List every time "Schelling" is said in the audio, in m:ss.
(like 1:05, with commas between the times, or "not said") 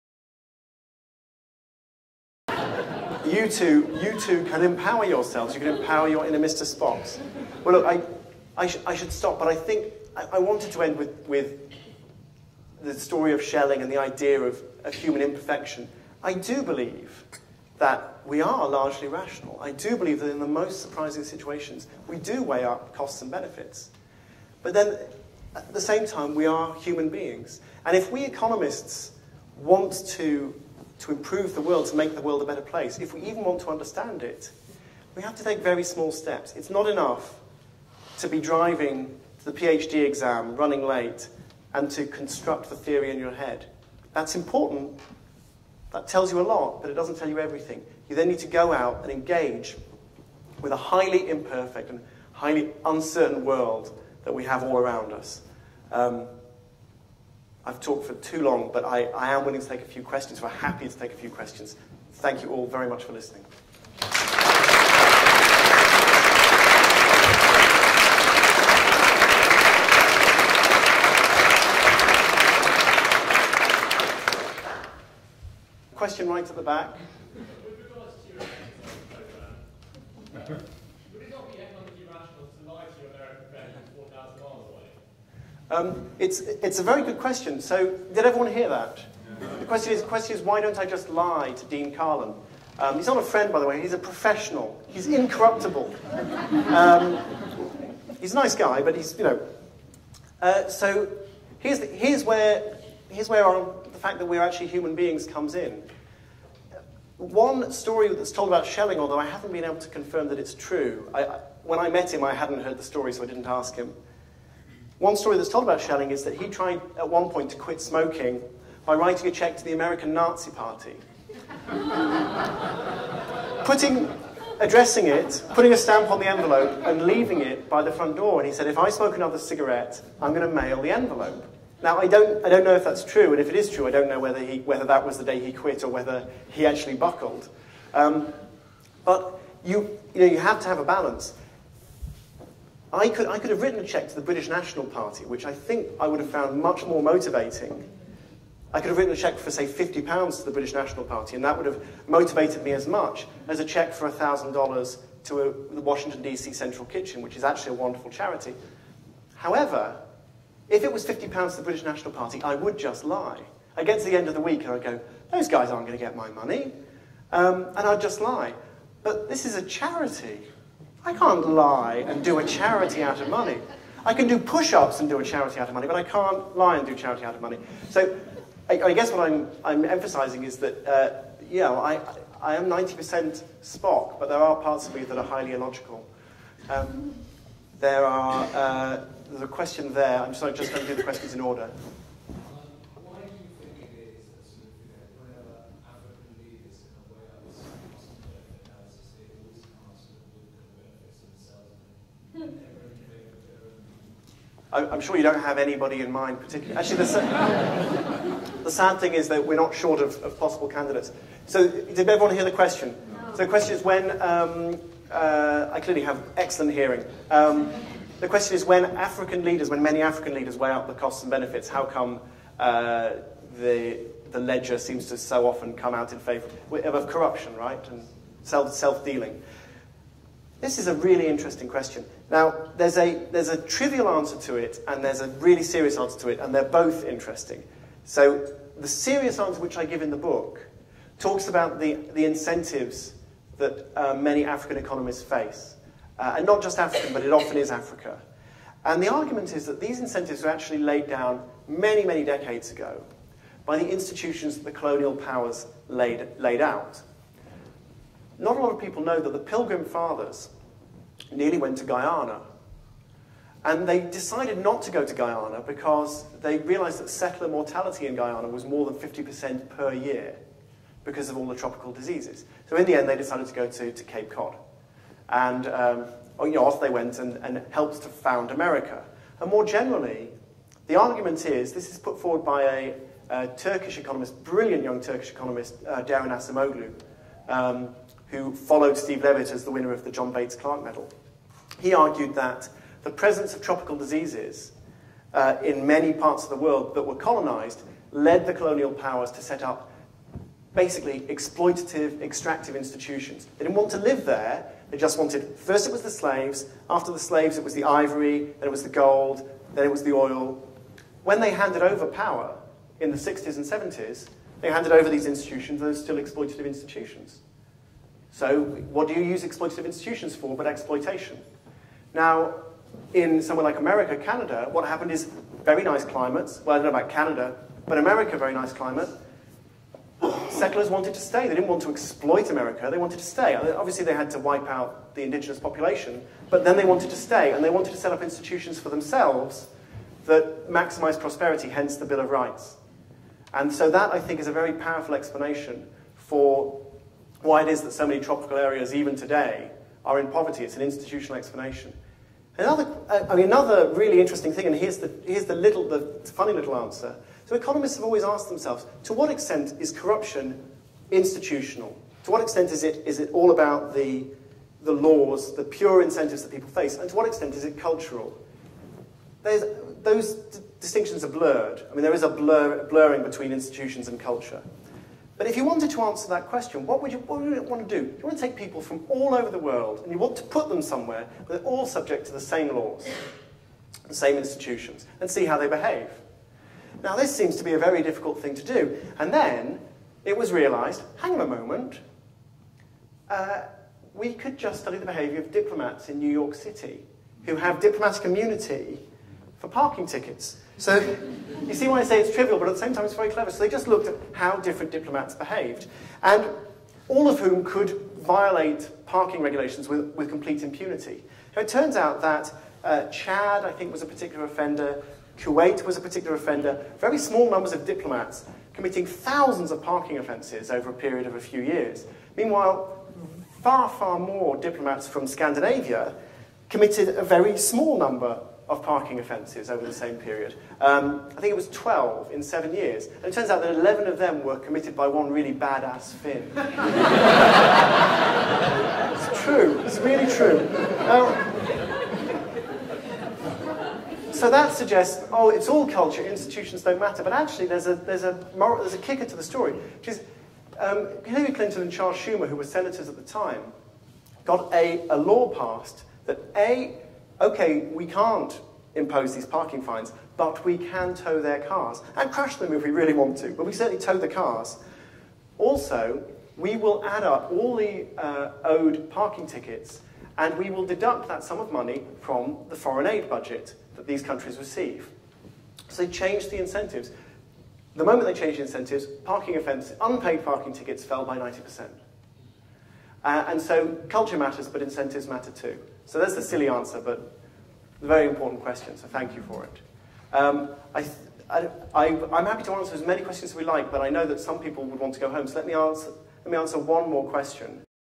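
0:13, 1:48, 1:55.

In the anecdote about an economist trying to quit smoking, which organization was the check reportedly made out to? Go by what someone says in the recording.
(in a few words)
American Nazi Party.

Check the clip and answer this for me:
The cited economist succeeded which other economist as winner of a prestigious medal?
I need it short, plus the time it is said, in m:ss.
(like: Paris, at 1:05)
Steve Levitt, at 4:48.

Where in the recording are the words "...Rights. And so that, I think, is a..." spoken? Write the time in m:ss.
5:42.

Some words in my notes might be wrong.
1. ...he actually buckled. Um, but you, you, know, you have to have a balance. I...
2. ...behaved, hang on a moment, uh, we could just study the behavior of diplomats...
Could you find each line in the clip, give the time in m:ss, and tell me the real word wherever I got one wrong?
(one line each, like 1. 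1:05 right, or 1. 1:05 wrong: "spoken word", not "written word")
1. 2:16 right
2. 6:30 wrong: "realized", not "behaved".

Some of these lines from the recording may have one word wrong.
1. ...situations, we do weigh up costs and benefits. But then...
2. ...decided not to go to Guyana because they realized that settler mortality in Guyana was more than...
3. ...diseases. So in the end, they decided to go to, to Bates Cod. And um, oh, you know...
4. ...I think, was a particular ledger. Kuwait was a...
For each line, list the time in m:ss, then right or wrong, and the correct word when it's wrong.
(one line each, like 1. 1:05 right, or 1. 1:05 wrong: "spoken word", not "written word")
1. 0:21 right
2. 4:23 right
3. 4:31 wrong: "Cape", not "Bates"
4. 6:53 wrong: "offender", not "ledger".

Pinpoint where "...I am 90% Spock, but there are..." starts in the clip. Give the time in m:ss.
3:02.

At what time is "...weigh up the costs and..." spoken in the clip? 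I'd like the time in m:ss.
3:40.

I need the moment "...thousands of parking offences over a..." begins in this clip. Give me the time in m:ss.
6:59.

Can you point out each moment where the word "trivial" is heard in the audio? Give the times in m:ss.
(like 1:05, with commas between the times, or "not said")
3:53, 6:42.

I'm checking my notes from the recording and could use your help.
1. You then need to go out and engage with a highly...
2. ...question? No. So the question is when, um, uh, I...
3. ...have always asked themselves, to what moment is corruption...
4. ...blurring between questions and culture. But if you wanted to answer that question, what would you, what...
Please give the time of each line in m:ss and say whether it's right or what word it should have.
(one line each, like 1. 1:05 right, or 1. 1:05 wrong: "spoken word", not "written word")
1. 0:48 right
2. 3:32 right
3. 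5:57 wrong: "extent", not "moment"
4. 6:12 wrong: "institutions", not "questions".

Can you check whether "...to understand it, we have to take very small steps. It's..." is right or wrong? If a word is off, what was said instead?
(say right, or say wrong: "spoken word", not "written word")
right.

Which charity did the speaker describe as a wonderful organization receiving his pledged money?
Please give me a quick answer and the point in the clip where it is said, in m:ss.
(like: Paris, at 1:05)
Washington, D.C. Central Kitchen, at 2:35.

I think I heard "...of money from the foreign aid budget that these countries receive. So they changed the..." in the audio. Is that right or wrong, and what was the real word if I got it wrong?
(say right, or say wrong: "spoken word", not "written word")
right.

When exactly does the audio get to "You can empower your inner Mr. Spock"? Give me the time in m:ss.
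0:05.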